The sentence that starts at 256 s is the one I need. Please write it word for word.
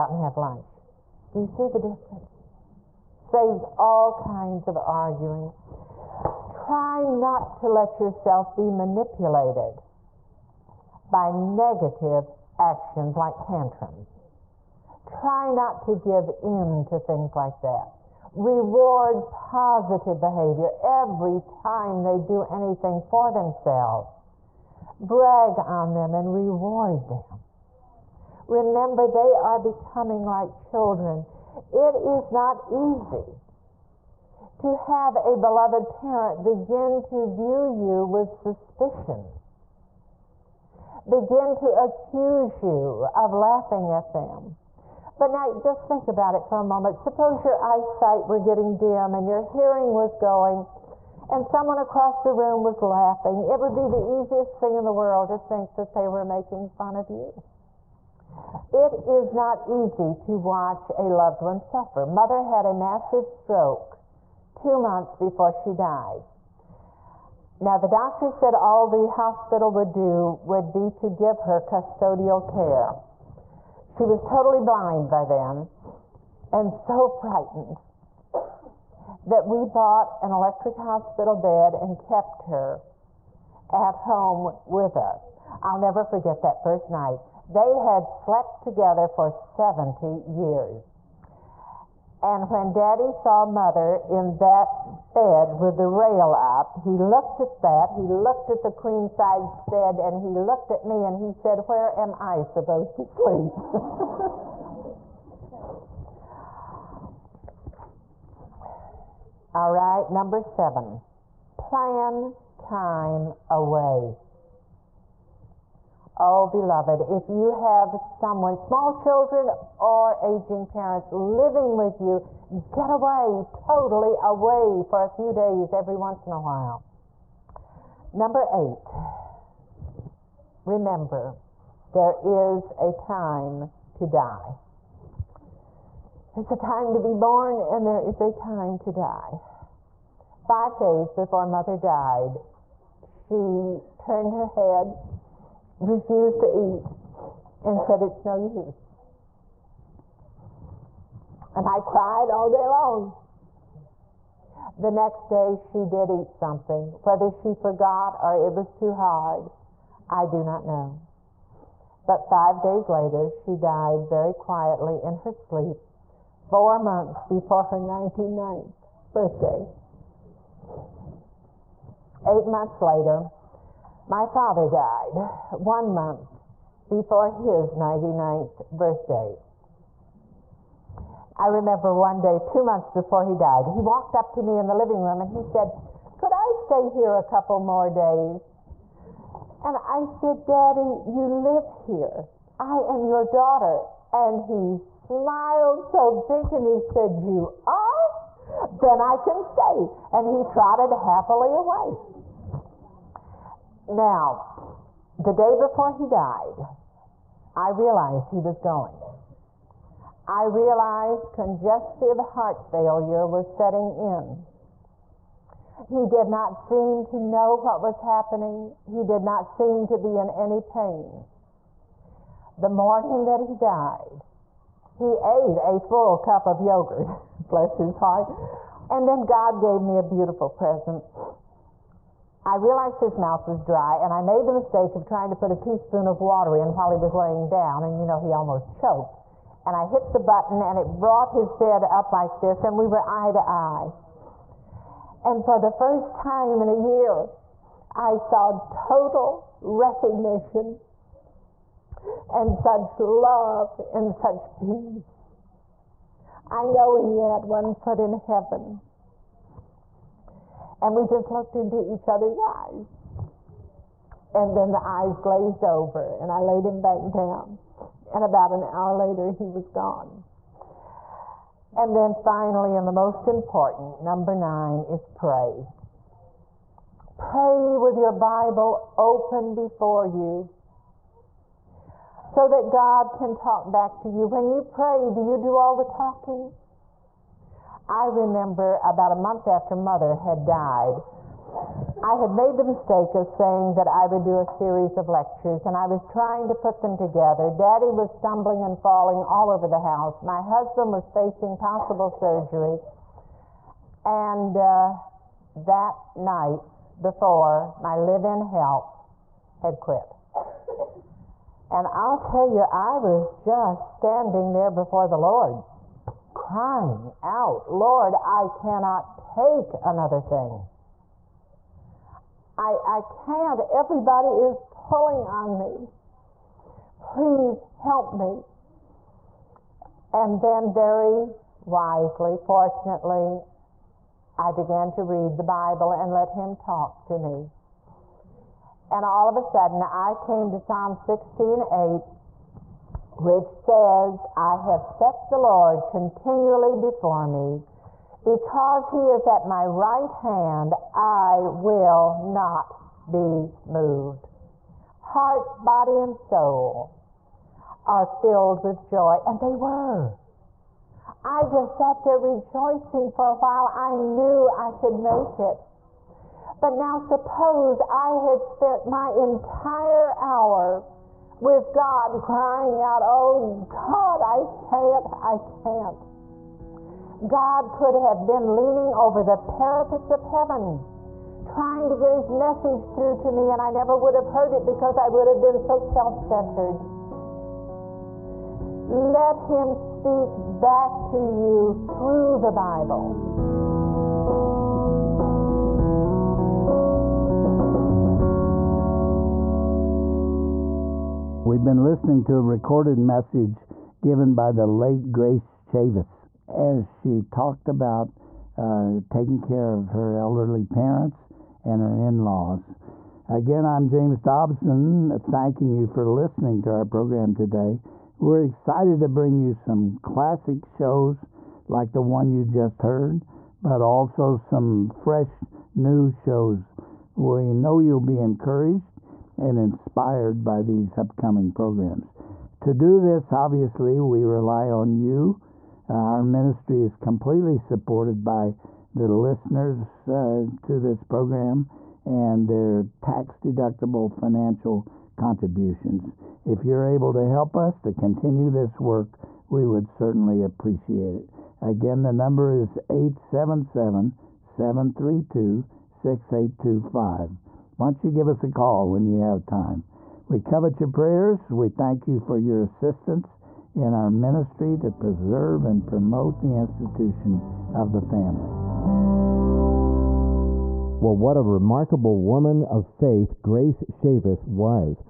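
I know he had one foot in heaven and we just looked into each other's eyes.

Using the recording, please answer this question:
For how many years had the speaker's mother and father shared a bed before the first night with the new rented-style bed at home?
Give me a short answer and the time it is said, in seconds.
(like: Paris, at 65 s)
70 years, at 89 s.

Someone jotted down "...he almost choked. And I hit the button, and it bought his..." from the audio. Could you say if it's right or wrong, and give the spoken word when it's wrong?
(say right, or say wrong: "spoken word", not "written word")
wrong: "brought", not "bought".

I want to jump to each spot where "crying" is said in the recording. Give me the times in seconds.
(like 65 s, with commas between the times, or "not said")
316 s, 372 s.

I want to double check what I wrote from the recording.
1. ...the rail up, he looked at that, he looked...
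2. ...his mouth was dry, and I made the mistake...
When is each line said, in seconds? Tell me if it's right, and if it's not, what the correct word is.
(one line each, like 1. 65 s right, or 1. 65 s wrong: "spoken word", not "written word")
1. 95 s right
2. 233 s right.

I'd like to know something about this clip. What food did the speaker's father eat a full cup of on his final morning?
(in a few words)
Yogurt.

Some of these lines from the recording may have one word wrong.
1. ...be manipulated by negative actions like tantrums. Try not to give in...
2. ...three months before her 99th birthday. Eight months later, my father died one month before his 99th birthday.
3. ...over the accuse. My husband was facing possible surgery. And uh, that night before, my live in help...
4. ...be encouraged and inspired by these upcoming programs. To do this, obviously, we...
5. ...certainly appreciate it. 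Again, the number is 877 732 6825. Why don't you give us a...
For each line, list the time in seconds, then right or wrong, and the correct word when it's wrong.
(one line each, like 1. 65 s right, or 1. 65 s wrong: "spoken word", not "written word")
1. 8 s right
2. 166 s wrong: "four", not "three"
3. 299 s wrong: "house", not "accuse"
4. 428 s right
5. 449 s right.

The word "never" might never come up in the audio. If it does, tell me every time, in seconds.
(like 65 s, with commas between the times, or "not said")
85 s, 383 s.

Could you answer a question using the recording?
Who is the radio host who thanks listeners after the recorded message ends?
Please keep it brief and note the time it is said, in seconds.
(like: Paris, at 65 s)
James Dobson, at 413 s.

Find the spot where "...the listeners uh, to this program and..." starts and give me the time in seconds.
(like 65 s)
438 s.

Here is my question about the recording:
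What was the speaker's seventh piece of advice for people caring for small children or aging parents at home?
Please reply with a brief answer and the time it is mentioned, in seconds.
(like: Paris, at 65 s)
Plan time away, at 111 s.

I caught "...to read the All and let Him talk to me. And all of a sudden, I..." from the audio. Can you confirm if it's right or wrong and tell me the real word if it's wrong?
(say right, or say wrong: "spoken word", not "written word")
wrong: "Bible", not "All".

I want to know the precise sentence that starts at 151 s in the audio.
And I cried all day long.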